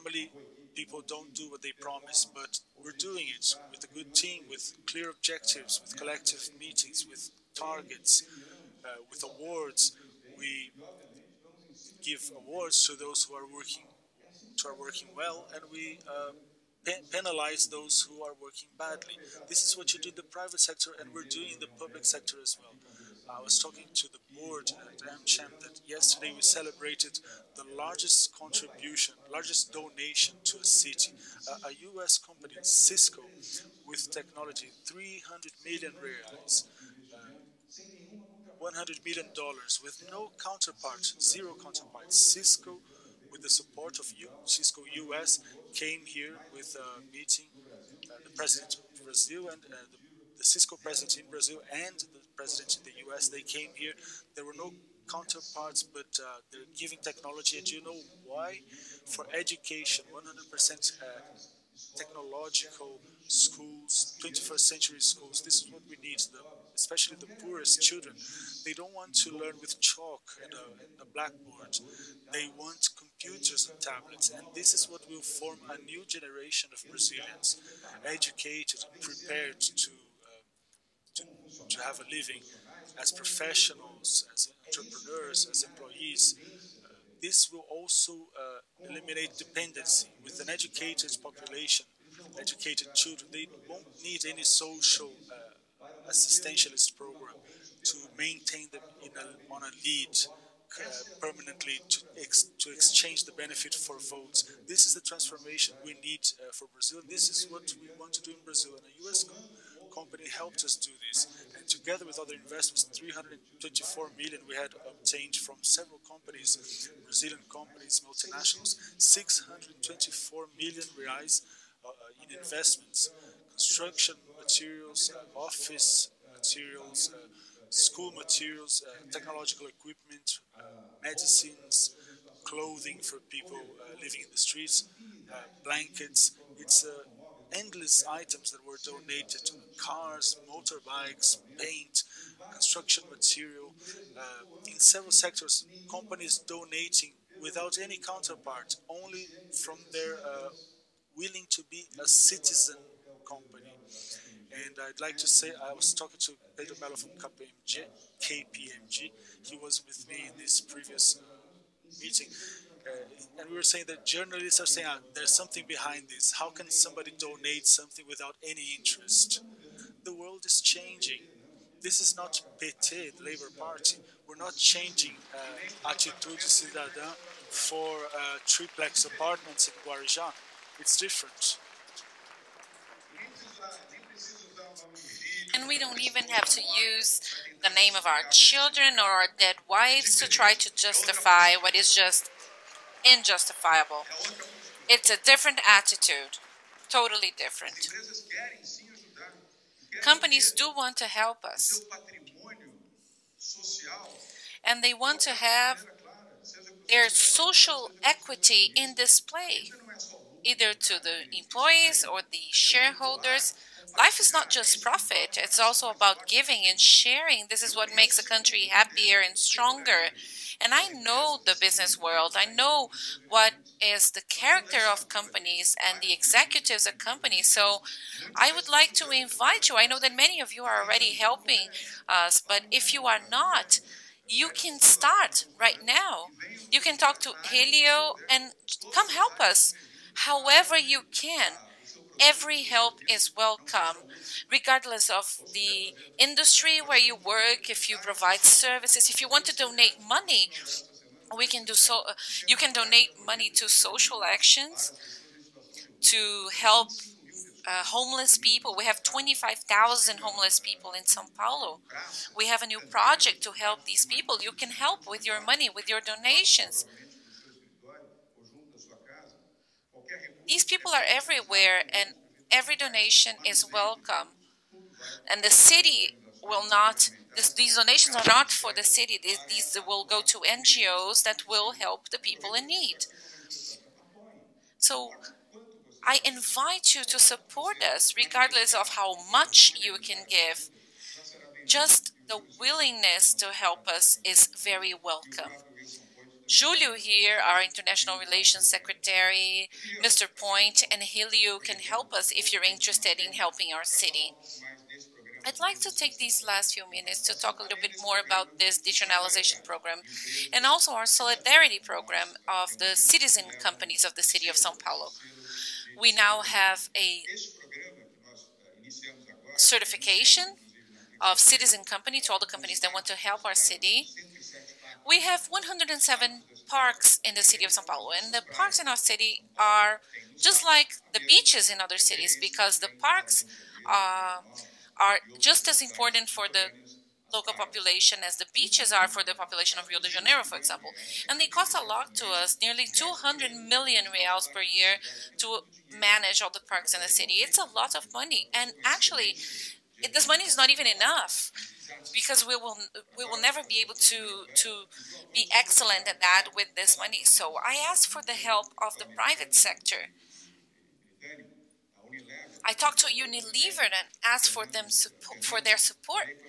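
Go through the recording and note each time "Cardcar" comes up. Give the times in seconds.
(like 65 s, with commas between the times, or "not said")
not said.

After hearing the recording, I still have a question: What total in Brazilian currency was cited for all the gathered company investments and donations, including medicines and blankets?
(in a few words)
624 million reais.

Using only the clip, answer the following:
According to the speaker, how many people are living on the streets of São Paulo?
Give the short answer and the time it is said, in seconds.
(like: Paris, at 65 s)
25,000, at 259 s.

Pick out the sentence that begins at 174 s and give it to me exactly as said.
We're not changing uh, Atitude Cidadã for uh, triplex apartments in Guarujá.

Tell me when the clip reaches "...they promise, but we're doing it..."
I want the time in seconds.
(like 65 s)
1 s.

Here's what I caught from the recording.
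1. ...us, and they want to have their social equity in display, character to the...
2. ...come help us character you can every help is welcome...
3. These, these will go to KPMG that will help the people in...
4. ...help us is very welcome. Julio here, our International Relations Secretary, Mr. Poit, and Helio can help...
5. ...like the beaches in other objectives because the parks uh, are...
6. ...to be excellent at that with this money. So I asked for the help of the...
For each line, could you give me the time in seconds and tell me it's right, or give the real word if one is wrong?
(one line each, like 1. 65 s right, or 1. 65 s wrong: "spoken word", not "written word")
1. 201 s wrong: "either", not "character"
2. 238 s wrong: "however", not "character"
3. 279 s wrong: "NGOs", not "KPMG"
4. 293 s right
5. 330 s wrong: "cities", not "objectives"
6. 354 s right.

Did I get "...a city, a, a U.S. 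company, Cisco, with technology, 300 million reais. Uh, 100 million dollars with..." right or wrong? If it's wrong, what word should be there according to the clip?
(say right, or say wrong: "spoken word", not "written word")
right.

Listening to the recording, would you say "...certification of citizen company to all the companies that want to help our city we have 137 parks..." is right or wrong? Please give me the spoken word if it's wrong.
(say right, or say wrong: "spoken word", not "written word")
wrong: "107", not "137".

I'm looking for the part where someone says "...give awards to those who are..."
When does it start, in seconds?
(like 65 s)
12 s.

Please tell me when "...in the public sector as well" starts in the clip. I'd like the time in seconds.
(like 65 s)
21 s.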